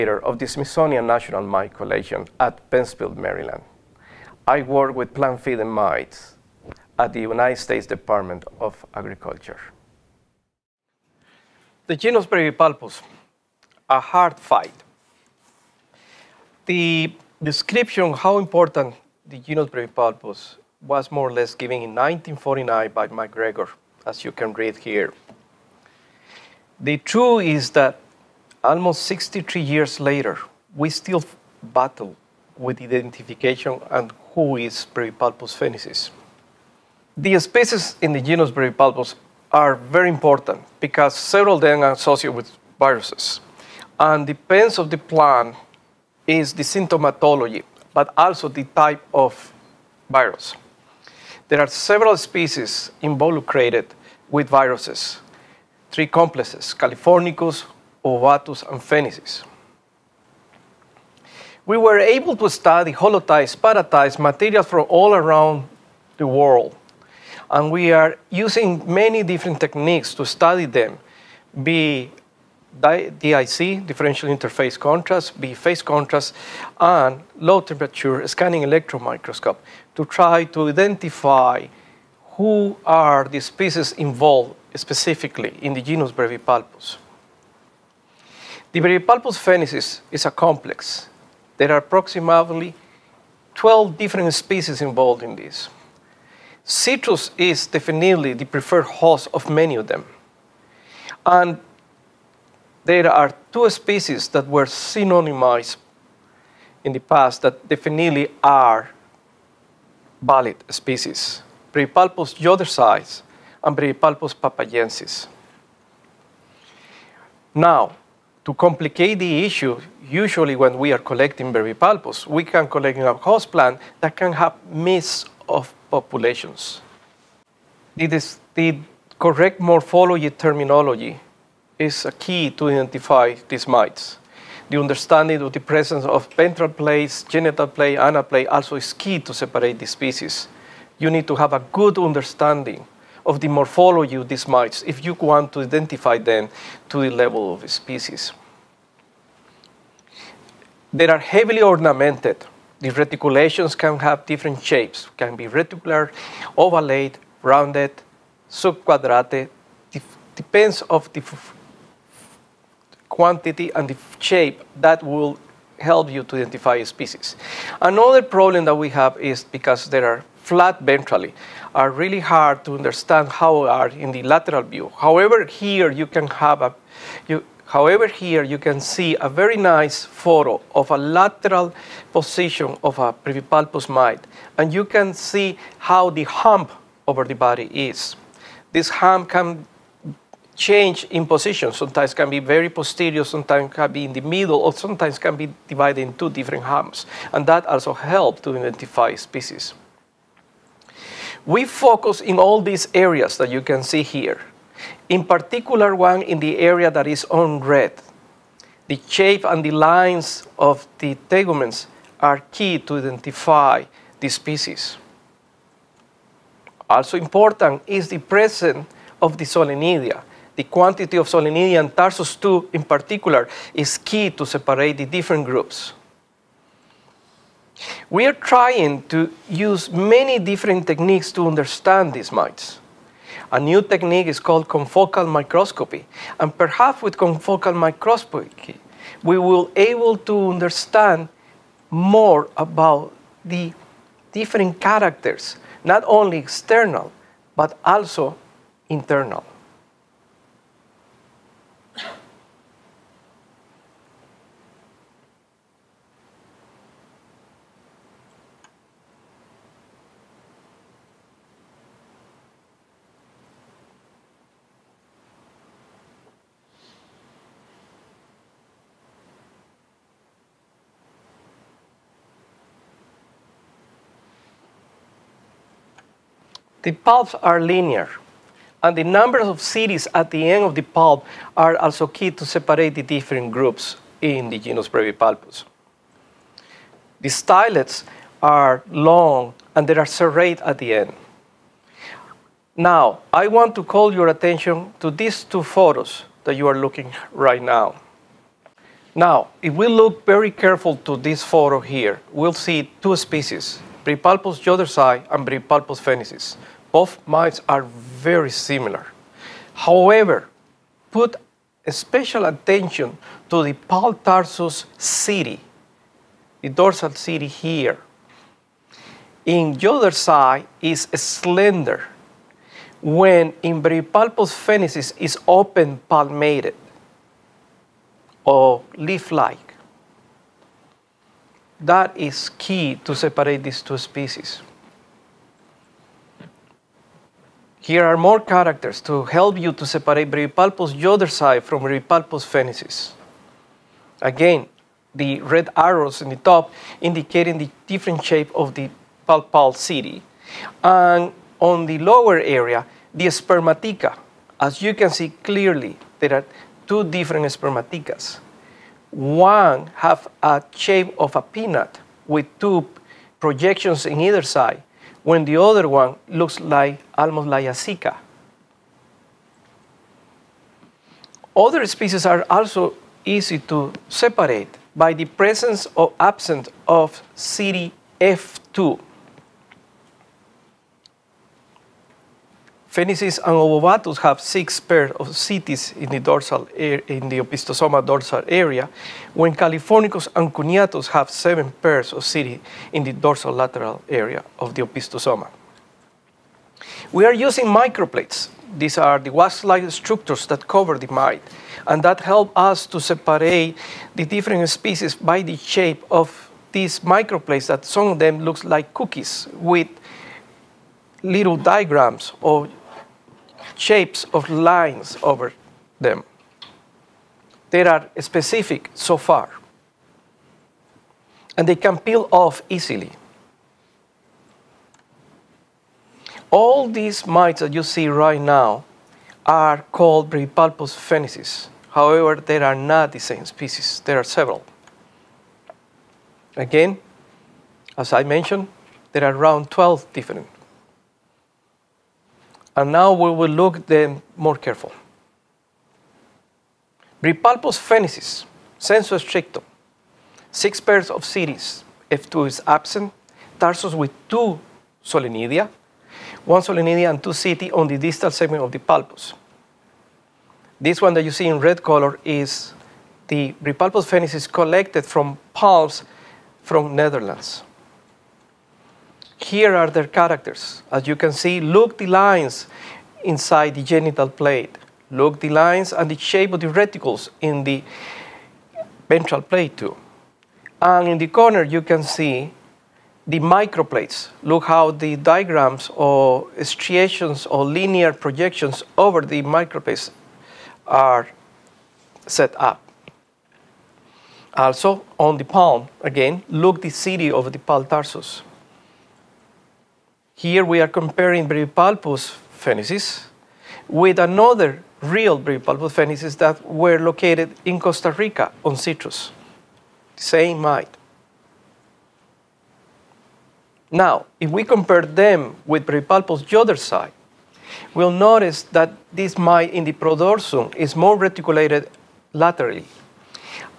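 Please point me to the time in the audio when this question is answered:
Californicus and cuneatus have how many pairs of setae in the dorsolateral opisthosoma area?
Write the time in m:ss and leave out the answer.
6:31.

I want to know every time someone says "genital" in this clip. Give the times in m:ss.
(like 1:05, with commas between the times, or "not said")
2:17, 7:53.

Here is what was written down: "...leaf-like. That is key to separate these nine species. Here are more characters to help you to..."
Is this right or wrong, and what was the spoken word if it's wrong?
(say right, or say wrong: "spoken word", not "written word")
wrong: "two", not "nine".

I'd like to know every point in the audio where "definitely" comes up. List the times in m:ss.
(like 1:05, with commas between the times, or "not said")
1:37, 1:47.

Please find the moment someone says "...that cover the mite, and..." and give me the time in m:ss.
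6:40.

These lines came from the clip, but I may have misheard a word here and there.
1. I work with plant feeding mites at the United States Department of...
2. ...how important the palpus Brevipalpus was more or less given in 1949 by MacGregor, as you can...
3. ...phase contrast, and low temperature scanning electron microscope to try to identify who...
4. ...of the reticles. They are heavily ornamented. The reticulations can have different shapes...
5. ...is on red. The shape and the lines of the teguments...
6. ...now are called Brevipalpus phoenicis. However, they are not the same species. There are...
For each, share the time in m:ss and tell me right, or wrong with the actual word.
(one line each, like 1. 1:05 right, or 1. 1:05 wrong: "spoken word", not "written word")
1. 0:04 right
2. 0:18 wrong: "genus", not "palpus"
3. 1:15 right
4. 2:27 wrong: "species", not "reticles"
5. 3:27 right
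6. 7:08 right.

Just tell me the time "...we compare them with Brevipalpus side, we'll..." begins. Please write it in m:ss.
8:34.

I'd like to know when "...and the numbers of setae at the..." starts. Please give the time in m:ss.
4:38.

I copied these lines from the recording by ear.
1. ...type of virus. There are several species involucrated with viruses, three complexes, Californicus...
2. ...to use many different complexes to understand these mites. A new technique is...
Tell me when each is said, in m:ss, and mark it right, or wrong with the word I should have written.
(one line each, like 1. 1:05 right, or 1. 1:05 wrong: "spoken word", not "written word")
1. 0:48 right
2. 3:49 wrong: "techniques", not "complexes".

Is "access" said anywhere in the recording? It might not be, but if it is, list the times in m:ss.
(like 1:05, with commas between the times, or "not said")
not said.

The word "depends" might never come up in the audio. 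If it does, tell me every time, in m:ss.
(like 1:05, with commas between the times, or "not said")
0:44, 2:40.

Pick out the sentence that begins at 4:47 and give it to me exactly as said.
The stylets are long and they are serrate at the end.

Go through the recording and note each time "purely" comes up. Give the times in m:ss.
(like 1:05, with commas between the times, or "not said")
not said.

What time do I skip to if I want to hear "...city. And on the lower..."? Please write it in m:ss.
5:49.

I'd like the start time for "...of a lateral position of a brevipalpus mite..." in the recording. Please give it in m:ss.
3:00.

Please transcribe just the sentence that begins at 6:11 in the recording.
Other species are also easy to separate by the presence or absence of CDF2.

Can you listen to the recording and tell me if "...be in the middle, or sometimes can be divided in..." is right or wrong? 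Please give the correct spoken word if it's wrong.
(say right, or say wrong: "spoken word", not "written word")
right.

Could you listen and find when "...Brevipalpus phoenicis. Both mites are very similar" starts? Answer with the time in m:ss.
5:05.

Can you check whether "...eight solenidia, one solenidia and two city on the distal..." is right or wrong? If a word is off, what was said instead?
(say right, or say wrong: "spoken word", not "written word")
wrong: "two", not "eight".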